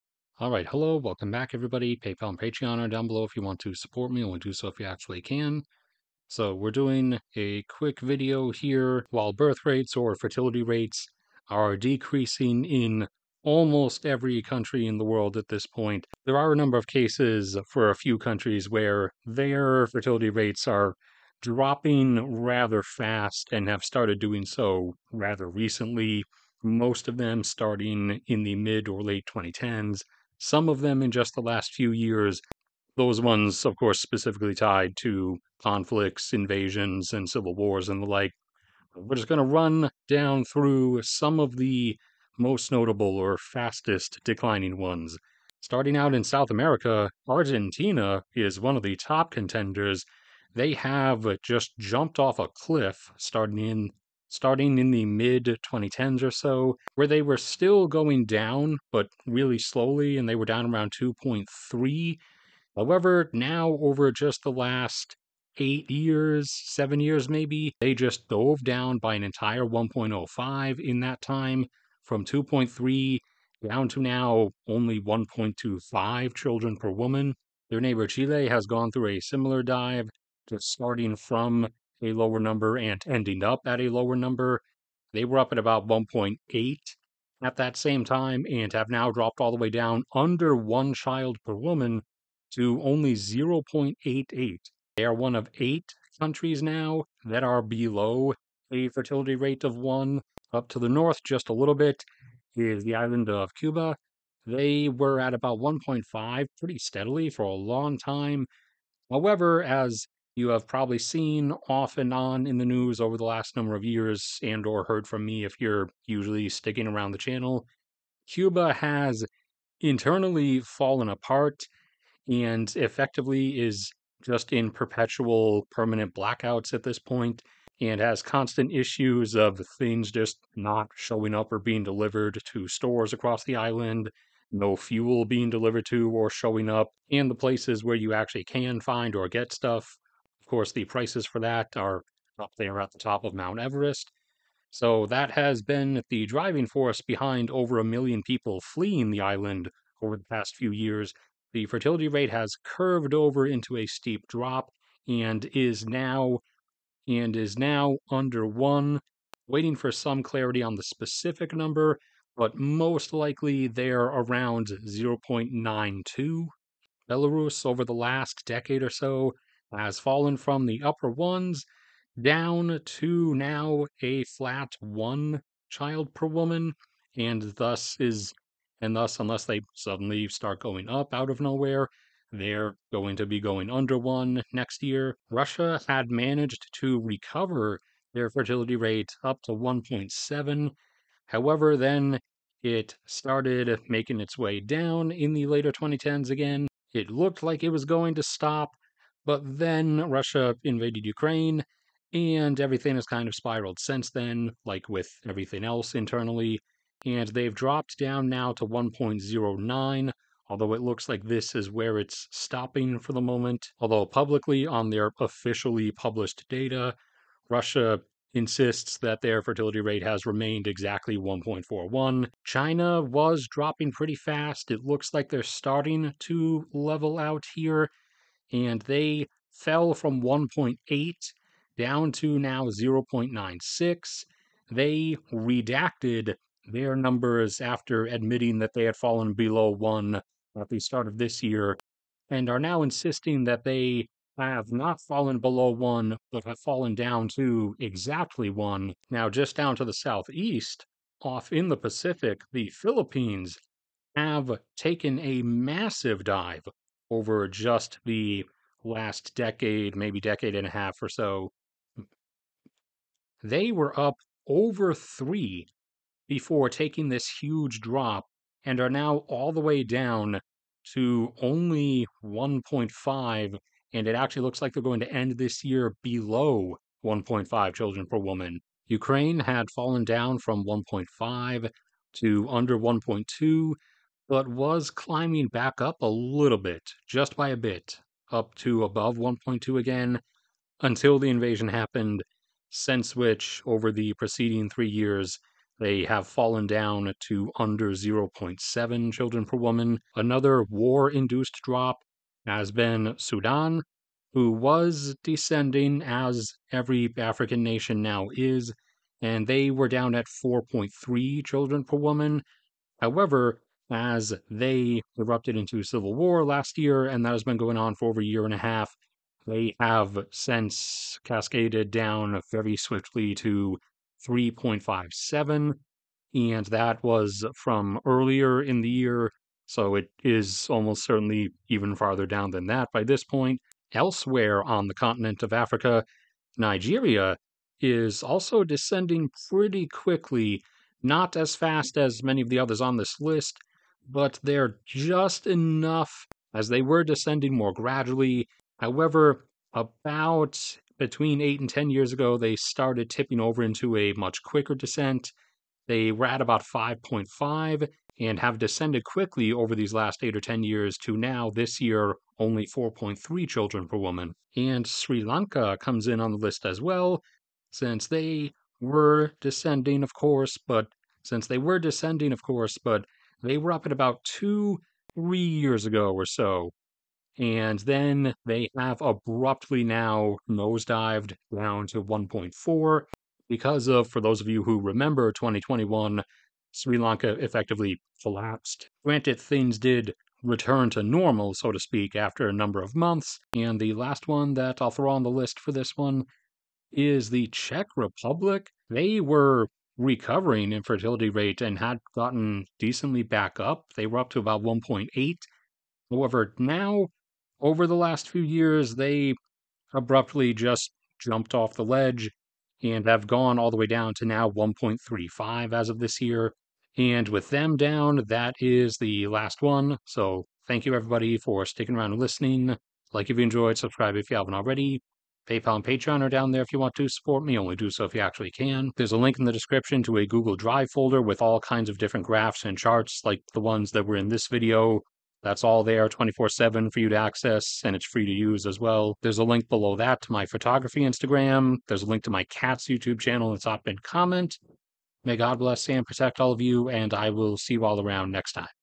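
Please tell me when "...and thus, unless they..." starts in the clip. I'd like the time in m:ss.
2:58.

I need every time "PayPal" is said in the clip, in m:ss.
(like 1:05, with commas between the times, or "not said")
0:01, 7:05.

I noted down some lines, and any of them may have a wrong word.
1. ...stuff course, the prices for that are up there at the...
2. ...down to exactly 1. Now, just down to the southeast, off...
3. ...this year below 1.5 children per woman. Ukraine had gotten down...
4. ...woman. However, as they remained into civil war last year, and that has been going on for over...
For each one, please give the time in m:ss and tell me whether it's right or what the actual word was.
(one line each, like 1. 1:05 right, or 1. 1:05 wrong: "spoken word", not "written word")
1. 2:19 right
2. 4:06 right
3. 4:35 wrong: "fallen", not "gotten"
4. 5:11 wrong: "erupted", not "remained".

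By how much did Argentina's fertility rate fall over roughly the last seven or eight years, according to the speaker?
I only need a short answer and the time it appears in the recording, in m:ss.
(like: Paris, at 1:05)
1.05, at 1:09.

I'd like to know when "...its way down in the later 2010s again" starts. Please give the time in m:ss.
3:14.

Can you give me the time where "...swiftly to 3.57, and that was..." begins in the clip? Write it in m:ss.
5:22.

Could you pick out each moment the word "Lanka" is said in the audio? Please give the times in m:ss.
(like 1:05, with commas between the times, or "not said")
6:05, 6:26.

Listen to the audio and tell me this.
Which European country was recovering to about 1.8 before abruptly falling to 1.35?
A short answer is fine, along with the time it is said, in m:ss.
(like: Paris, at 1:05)
Czech Republic, at 6:37.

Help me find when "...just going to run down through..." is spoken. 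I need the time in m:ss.
0:39.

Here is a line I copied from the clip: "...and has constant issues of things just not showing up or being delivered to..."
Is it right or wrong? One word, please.
right.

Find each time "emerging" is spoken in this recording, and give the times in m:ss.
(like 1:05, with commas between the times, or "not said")
not said.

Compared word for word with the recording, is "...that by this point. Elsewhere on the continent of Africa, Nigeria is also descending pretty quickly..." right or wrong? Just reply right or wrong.
right.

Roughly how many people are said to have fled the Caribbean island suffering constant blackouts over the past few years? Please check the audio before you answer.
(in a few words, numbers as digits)
over a million.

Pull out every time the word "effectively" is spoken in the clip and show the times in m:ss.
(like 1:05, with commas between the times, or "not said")
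2:02, 6:27.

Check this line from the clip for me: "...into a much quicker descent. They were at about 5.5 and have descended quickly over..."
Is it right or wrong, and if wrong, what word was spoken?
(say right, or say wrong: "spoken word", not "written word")
right.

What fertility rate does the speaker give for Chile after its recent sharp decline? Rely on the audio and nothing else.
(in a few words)
0.88.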